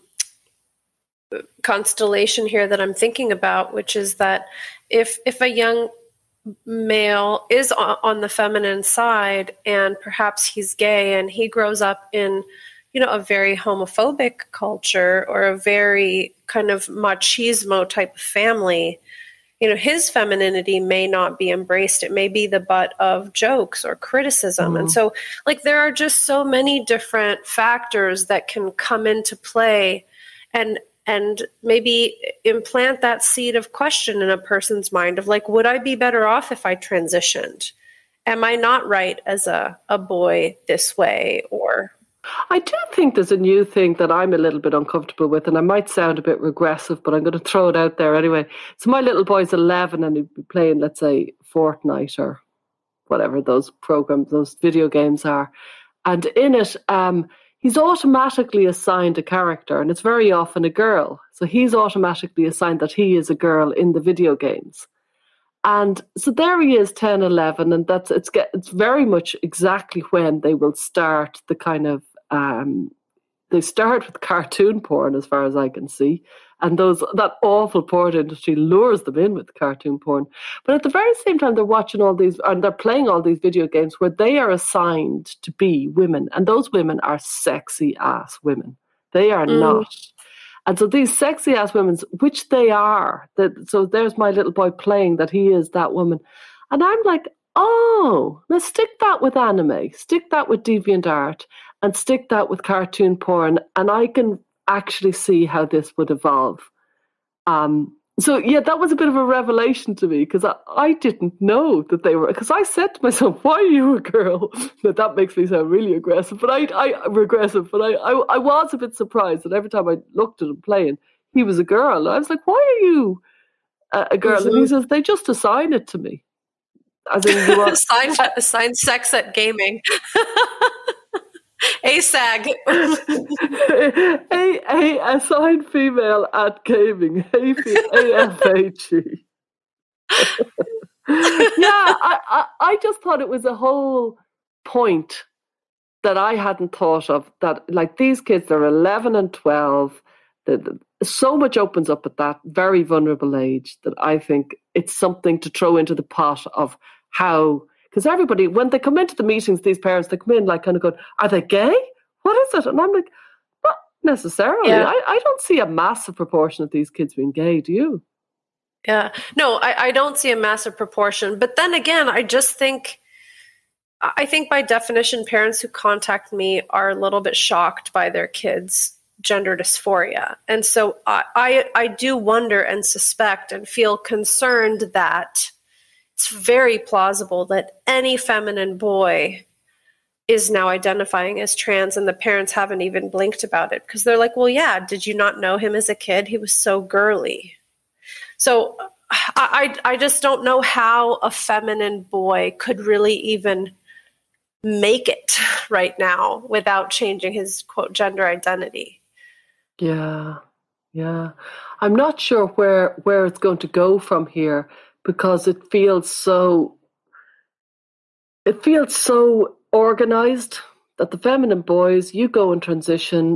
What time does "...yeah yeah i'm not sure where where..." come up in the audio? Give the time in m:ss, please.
3:29.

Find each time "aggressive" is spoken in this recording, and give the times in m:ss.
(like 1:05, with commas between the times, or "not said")
1:55.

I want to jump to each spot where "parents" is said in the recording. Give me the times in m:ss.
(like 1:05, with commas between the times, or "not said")
2:39, 2:55, 3:12.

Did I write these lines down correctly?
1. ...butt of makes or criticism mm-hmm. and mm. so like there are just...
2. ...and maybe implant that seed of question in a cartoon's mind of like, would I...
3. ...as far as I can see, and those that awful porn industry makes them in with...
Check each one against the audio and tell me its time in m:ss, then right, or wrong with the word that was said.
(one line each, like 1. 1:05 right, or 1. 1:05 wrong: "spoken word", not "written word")
1. 0:22 wrong: "jokes", not "makes"
2. 0:31 wrong: "person", not "cartoon"
3. 1:15 wrong: "lures", not "makes".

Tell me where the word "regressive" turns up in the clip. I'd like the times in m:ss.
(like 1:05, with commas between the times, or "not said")
0:46, 1:57.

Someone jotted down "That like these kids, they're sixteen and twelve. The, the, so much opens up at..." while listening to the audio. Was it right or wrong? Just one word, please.
wrong.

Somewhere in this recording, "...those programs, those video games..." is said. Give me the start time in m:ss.
0:53.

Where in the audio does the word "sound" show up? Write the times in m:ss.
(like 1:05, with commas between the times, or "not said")
0:45, 1:55.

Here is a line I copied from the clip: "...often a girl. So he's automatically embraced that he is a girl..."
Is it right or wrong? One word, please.
wrong.